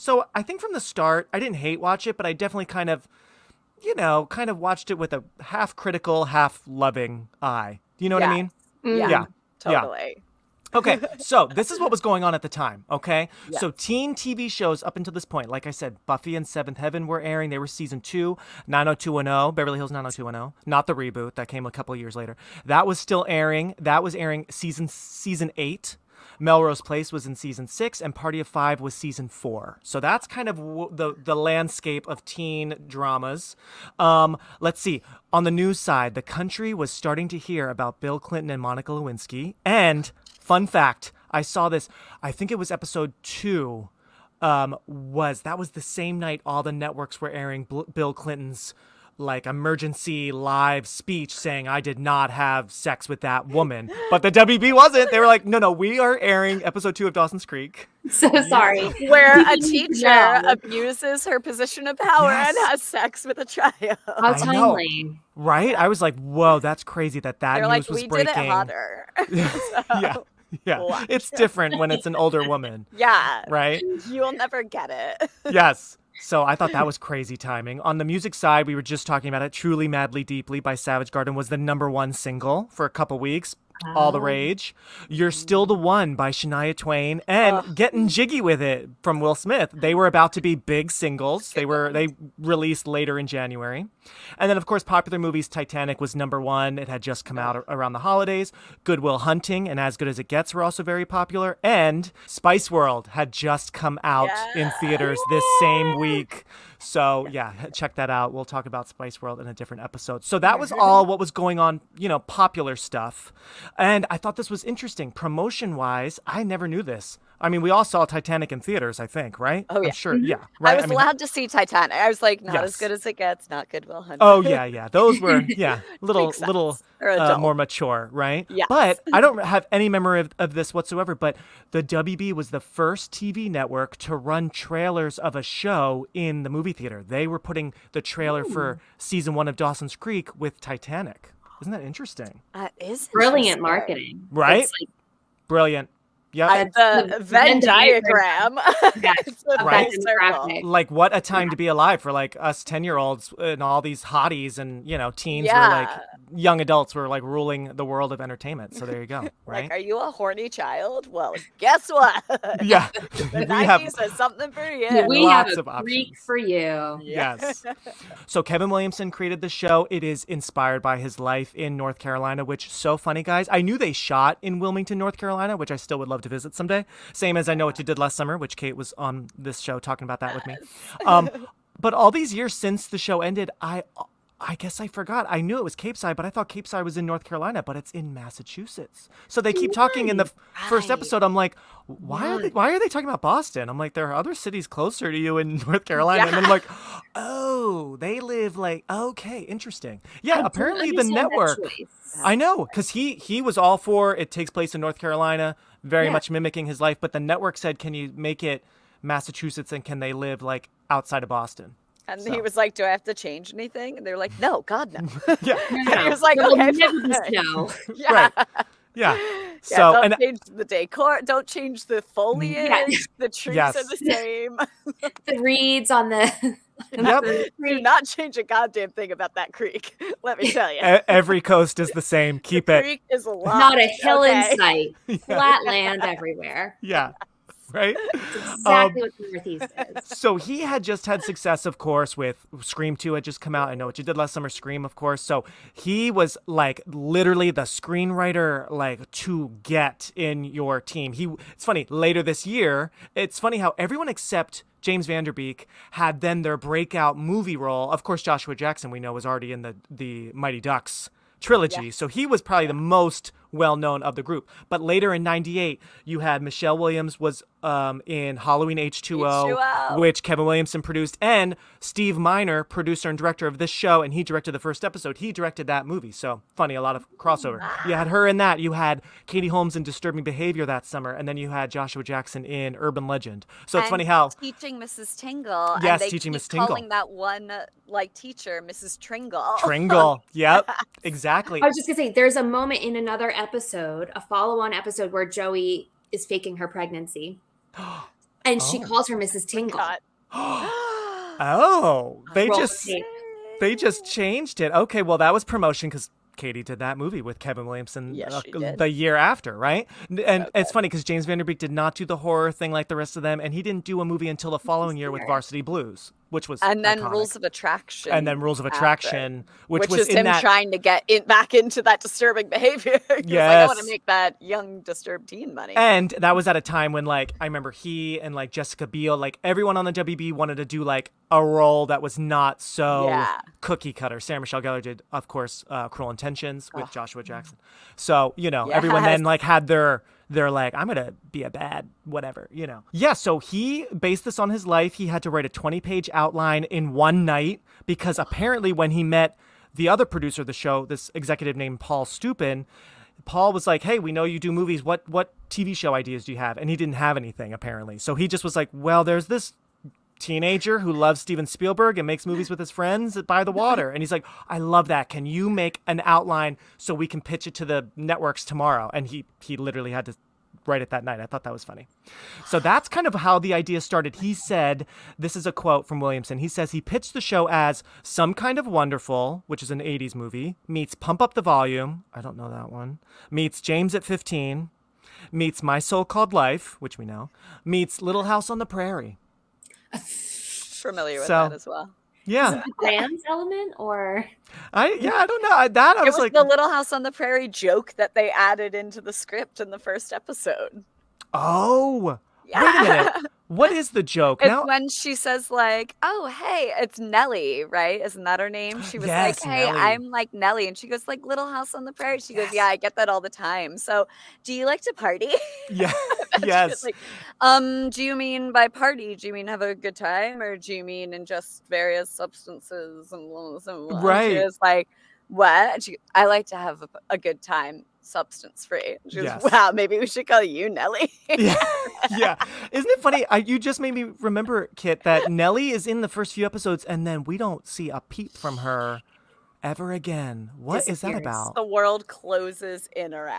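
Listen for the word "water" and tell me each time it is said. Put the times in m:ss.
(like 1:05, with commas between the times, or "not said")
6:03.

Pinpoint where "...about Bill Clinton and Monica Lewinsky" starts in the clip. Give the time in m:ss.
0:37.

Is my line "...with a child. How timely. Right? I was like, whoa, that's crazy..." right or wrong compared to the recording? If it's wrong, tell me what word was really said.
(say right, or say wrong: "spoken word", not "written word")
right.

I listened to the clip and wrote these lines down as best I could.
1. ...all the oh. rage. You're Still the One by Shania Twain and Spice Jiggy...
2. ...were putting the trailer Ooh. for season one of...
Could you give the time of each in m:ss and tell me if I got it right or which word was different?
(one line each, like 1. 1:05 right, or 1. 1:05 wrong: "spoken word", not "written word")
1. 1:23 wrong: "Getting", not "Spice"
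2. 2:17 right.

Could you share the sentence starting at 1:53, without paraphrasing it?
And I thought this was interesting.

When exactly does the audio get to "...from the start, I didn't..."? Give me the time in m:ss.
0:00.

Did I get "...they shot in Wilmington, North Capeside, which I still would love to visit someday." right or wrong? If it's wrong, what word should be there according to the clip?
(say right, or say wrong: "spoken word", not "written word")
wrong: "Carolina", not "Capeside".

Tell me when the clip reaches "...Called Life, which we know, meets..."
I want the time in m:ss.
6:26.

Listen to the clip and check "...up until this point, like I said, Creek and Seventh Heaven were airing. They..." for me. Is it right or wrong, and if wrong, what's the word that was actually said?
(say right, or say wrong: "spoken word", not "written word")
wrong: "Buffy", not "Creek".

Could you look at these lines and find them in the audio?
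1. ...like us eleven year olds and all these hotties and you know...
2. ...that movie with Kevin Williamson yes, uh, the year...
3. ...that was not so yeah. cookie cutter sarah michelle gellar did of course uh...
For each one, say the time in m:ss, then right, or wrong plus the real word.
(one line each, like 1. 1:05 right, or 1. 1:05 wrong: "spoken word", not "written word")
1. 2:32 wrong: "ten", not "eleven"
2. 5:06 right
3. 5:31 right.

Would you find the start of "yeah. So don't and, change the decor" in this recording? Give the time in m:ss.
3:39.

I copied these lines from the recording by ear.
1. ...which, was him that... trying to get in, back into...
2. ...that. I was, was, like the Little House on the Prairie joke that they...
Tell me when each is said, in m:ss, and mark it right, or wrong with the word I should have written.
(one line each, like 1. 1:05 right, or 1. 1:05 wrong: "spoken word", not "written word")
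1. 5:19 right
2. 6:35 right.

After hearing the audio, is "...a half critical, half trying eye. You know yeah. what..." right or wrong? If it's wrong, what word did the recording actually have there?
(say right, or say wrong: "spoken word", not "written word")
wrong: "loving", not "trying".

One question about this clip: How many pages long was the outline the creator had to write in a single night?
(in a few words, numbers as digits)
20.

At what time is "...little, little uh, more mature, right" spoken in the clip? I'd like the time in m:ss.
2:06.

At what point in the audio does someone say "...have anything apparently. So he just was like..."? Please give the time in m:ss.
5:56.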